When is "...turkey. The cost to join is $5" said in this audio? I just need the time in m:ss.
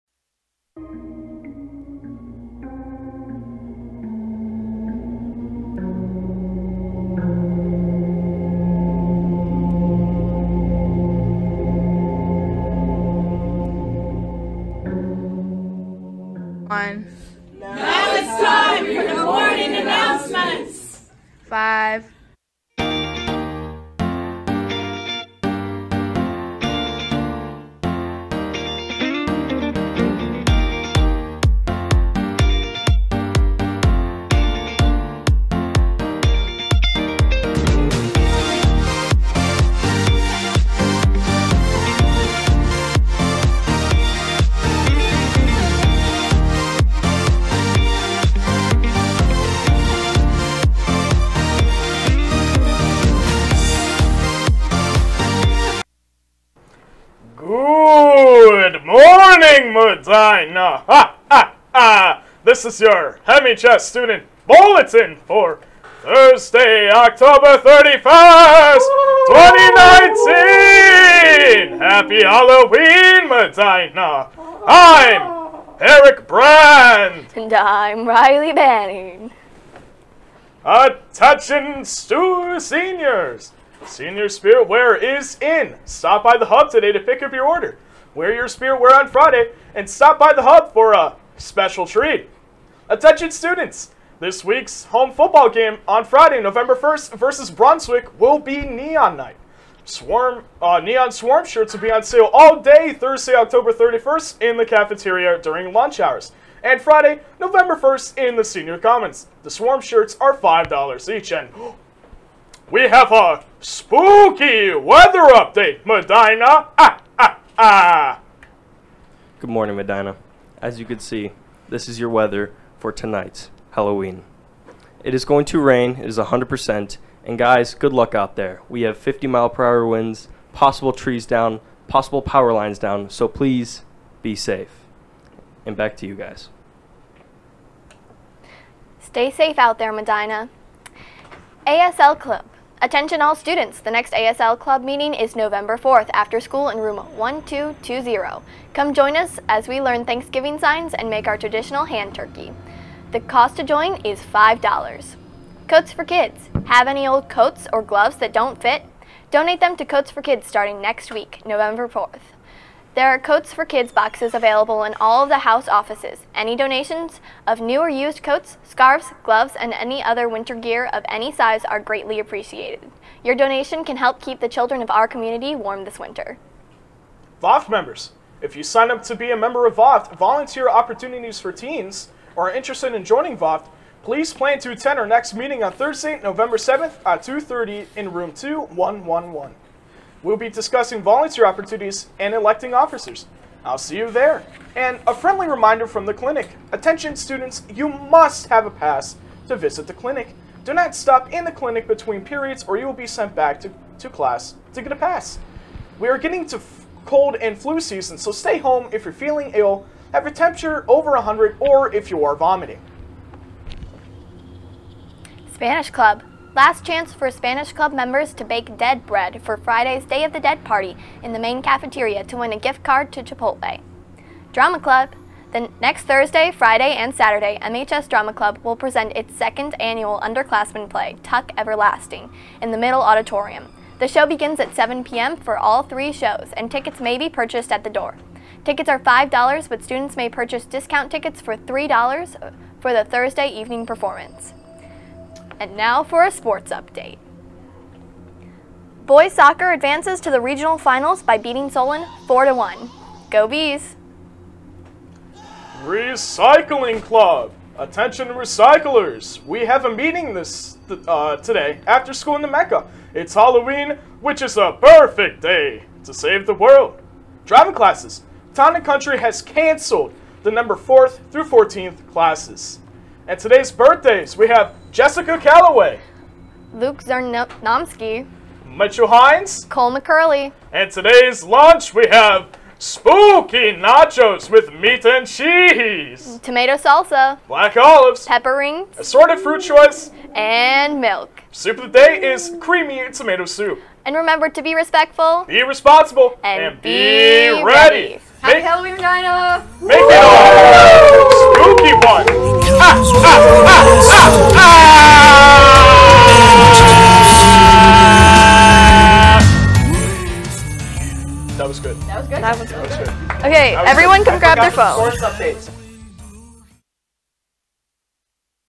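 2:32.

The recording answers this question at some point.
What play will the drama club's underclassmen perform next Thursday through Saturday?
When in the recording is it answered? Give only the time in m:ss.
3:51.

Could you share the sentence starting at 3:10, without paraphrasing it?
We'll be discussing volunteer opportunities and electing officers.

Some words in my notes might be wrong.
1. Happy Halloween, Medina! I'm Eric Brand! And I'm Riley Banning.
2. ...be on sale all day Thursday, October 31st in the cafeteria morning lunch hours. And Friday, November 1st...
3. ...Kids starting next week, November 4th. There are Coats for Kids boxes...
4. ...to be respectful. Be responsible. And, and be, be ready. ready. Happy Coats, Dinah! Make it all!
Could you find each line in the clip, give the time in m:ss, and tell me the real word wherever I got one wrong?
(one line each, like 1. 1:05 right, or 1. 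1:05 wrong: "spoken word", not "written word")
1. 1:11 right
2. 1:41 wrong: "during", not "morning"
3. 2:40 right
4. 4:54 wrong: "Halloween", not "Coats".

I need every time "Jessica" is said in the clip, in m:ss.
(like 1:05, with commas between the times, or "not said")
4:34.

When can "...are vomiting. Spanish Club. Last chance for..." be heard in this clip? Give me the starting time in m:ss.
3:32.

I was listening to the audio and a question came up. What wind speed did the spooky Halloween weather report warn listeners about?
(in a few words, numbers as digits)
50 mph.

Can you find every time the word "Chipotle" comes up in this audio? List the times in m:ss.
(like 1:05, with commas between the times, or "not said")
3:43.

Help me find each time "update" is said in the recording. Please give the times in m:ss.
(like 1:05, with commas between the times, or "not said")
1:55, 4:06.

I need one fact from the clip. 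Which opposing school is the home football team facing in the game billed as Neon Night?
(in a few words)
Brunswick.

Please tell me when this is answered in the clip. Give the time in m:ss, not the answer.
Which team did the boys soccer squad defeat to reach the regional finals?
4:11.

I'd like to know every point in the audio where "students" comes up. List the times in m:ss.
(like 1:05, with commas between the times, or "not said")
1:03, 1:33, 2:23, 3:17, 3:59.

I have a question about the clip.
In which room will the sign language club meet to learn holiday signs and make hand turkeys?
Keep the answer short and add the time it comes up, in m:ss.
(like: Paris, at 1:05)
Room 1220, at 2:26.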